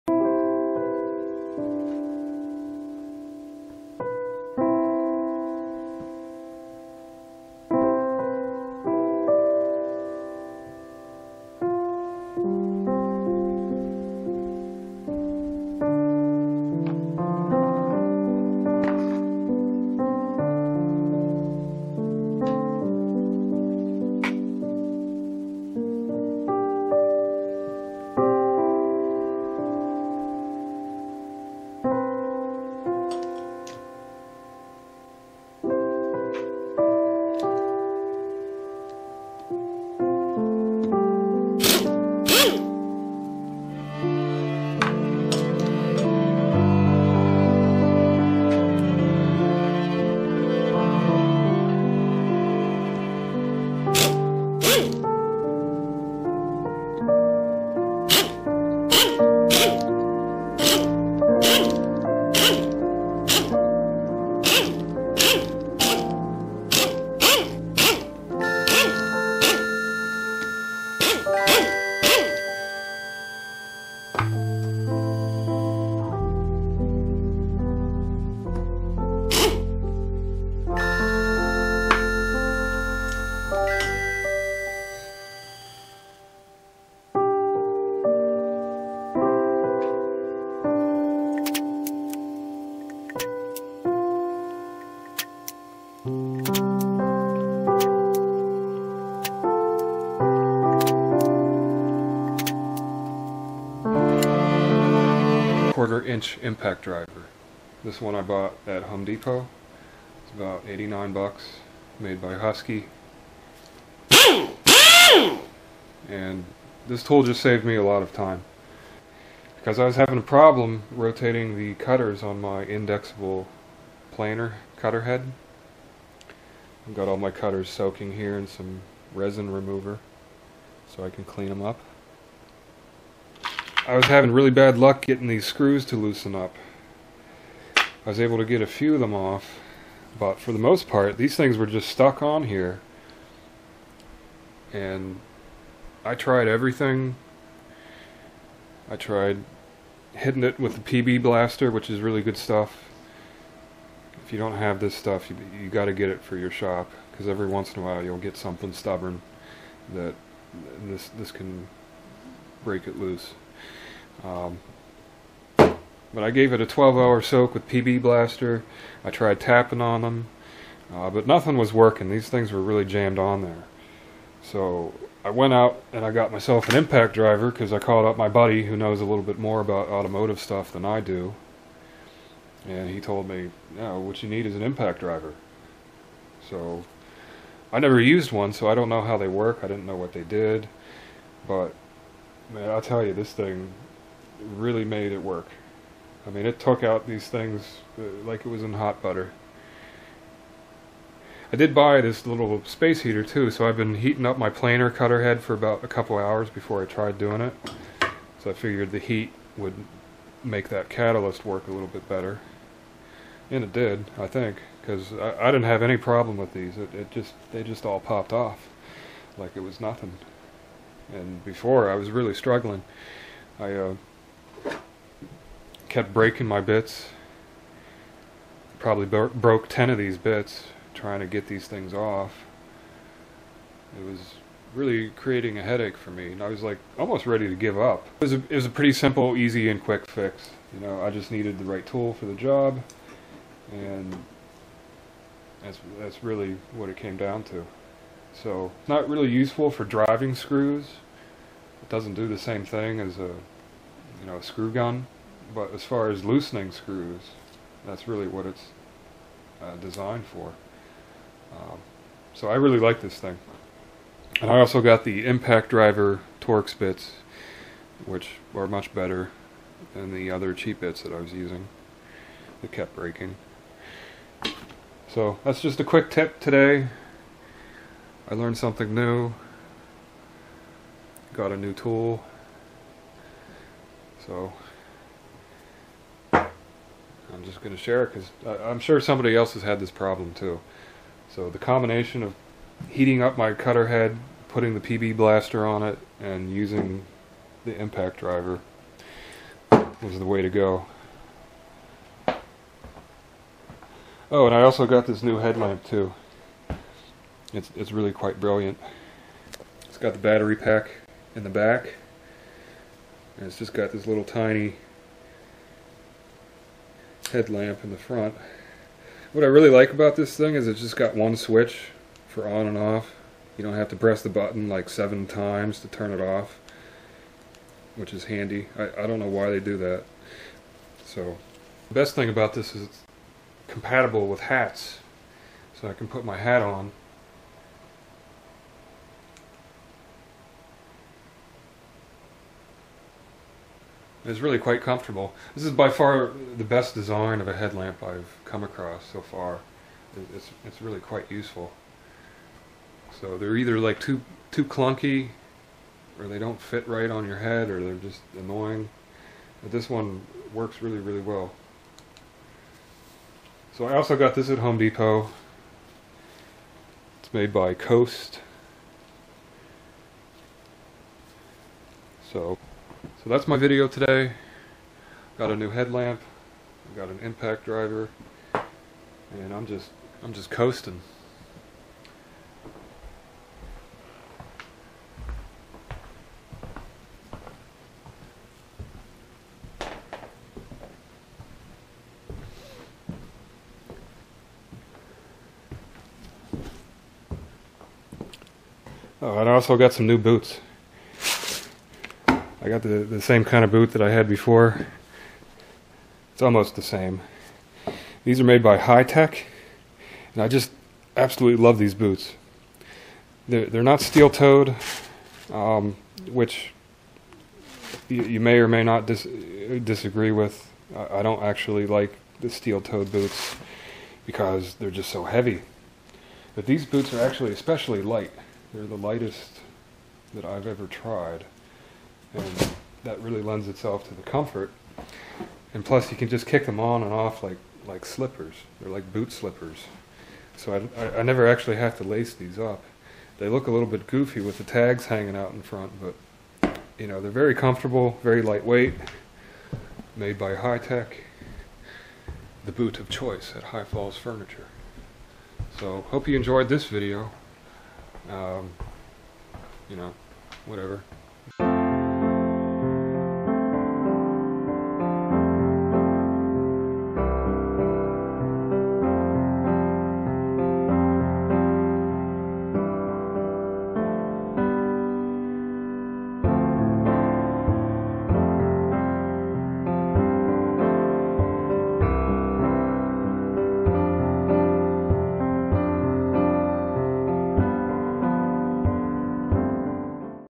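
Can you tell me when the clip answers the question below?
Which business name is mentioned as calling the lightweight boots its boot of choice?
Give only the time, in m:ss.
7:33.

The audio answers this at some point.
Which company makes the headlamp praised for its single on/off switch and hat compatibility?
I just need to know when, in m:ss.
6:07.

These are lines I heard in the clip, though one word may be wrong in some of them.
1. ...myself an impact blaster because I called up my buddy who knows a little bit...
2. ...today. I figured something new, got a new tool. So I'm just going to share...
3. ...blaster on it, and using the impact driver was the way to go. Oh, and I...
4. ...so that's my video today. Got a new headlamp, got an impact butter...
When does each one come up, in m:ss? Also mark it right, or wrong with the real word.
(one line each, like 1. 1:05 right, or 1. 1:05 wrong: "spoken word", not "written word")
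1. 2:56 wrong: "driver", not "blaster"
2. 4:36 wrong: "learned", not "figured"
3. 4:55 right
4. 6:13 wrong: "driver", not "butter".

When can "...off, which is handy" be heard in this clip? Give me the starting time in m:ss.
5:26.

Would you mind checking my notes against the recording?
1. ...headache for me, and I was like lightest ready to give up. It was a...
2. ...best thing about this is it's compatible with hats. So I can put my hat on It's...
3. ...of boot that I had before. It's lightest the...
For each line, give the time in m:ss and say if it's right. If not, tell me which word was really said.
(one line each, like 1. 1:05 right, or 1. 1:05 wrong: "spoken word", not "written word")
1. 3:55 wrong: "almost", not "lightest"
2. 5:31 right
3. 6:43 wrong: "almost", not "lightest".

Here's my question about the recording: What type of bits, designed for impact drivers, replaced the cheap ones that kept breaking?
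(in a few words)
Torx bits.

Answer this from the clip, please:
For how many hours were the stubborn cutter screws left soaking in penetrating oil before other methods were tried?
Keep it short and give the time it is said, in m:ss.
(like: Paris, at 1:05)
12, at 2:46.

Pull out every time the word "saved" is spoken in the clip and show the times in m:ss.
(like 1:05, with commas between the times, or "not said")
1:57.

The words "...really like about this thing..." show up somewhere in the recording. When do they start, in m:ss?
5:19.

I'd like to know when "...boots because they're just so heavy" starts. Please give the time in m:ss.
7:03.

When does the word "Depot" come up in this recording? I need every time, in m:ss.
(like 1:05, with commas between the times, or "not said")
1:49, 6:04.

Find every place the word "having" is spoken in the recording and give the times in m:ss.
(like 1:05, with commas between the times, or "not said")
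1:59, 2:14.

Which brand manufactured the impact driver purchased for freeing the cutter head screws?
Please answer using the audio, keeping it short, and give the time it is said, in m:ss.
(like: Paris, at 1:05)
Husky, at 1:52.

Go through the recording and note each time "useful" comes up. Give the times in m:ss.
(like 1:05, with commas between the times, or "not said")
4:09, 5:51.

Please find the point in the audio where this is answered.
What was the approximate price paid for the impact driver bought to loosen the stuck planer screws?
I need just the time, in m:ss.
1:50.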